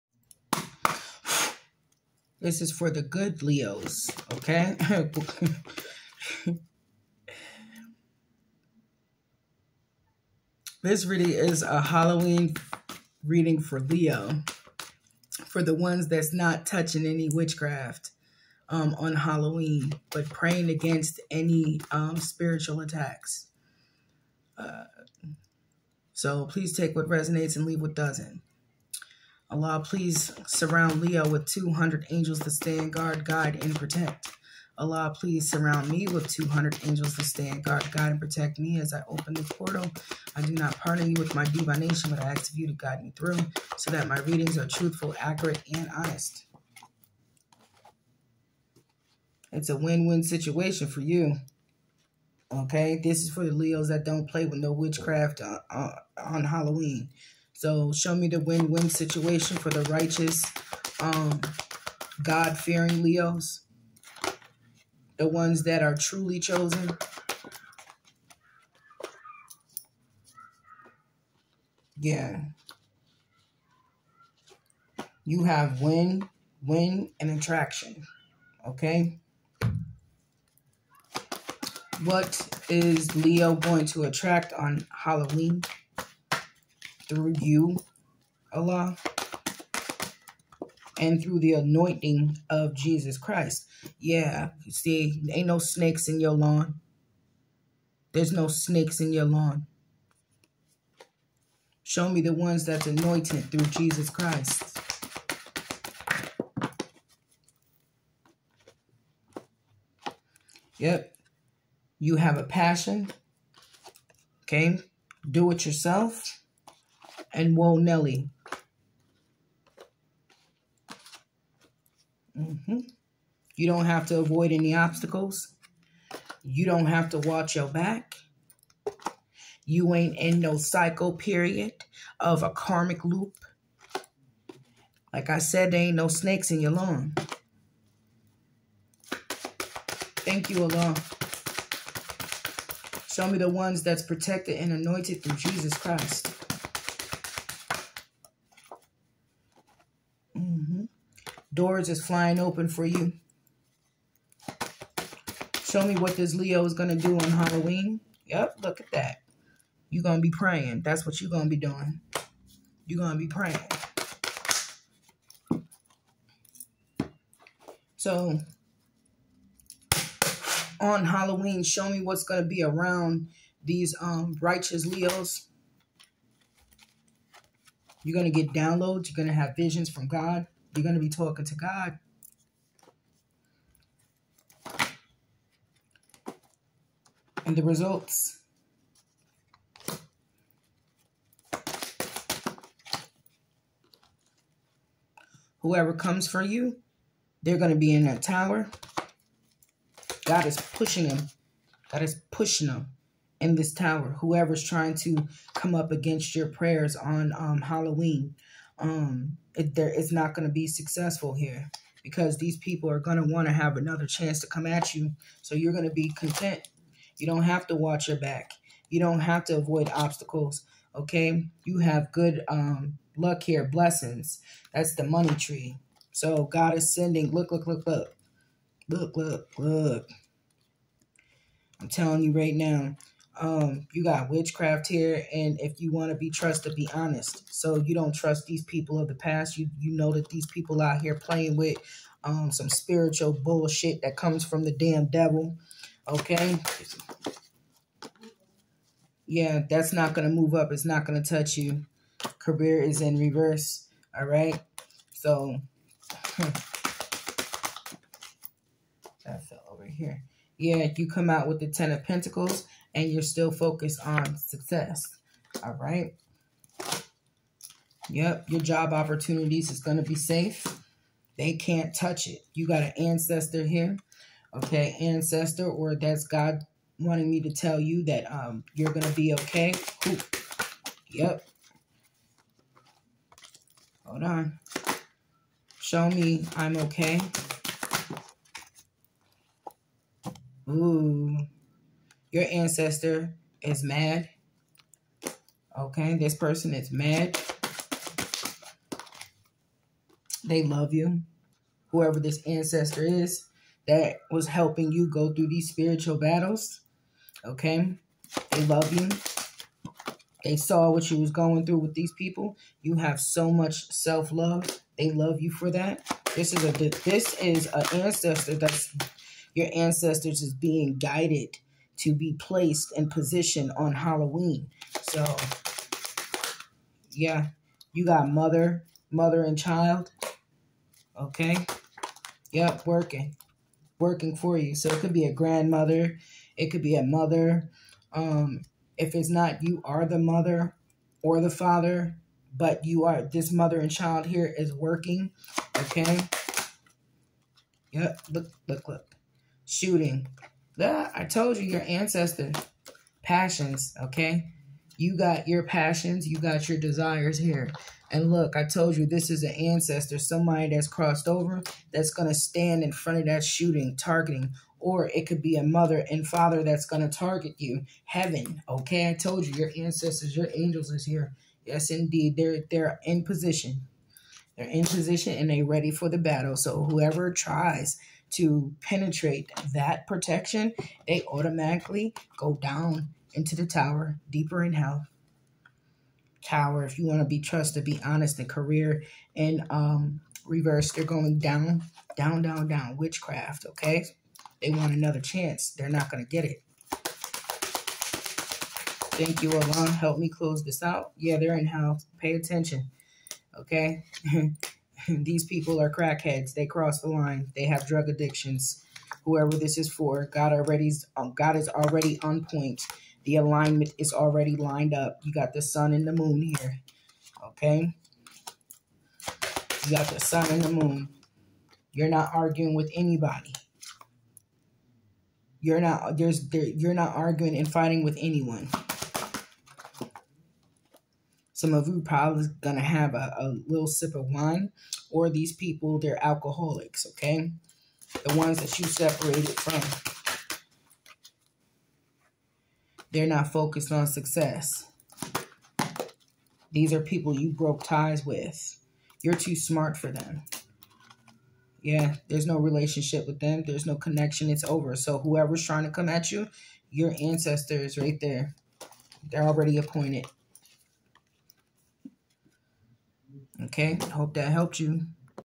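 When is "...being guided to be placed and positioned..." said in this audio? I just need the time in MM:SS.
05:20.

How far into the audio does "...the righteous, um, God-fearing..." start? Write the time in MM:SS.
00:59.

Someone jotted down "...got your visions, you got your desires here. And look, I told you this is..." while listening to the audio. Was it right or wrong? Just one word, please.
wrong.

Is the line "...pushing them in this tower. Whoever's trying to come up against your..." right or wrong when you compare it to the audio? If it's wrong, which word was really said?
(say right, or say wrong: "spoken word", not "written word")
right.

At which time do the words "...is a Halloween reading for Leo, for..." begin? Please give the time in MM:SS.
00:11.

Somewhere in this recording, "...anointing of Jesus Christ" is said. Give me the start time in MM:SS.
01:31.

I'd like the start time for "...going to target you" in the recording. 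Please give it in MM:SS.
06:06.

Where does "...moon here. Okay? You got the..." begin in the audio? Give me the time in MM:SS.
06:56.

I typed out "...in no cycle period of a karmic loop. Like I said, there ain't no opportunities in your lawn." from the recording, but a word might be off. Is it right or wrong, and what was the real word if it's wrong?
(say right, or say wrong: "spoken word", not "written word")
wrong: "snakes", not "opportunities".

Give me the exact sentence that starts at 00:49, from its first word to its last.
It's a win-win situation for you.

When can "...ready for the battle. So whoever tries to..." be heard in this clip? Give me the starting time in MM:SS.
06:15.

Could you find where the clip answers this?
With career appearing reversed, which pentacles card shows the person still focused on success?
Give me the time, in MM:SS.
04:21.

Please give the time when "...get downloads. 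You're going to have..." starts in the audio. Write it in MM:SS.
02:58.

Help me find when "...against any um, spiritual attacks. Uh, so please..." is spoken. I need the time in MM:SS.
00:20.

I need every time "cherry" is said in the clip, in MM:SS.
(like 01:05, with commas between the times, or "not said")
not said.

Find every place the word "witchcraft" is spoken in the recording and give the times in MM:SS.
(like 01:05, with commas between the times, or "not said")
00:17, 00:54, 03:54, 06:32.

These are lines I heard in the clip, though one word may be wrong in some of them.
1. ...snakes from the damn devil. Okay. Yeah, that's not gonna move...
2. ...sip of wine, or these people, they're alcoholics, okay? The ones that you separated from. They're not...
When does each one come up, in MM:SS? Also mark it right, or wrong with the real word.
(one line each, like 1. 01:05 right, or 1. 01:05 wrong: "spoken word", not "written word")
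1. 04:04 wrong: "comes", not "snakes"
2. 07:13 right.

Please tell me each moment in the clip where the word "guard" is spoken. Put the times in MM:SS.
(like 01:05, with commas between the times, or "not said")
00:32, 00:37.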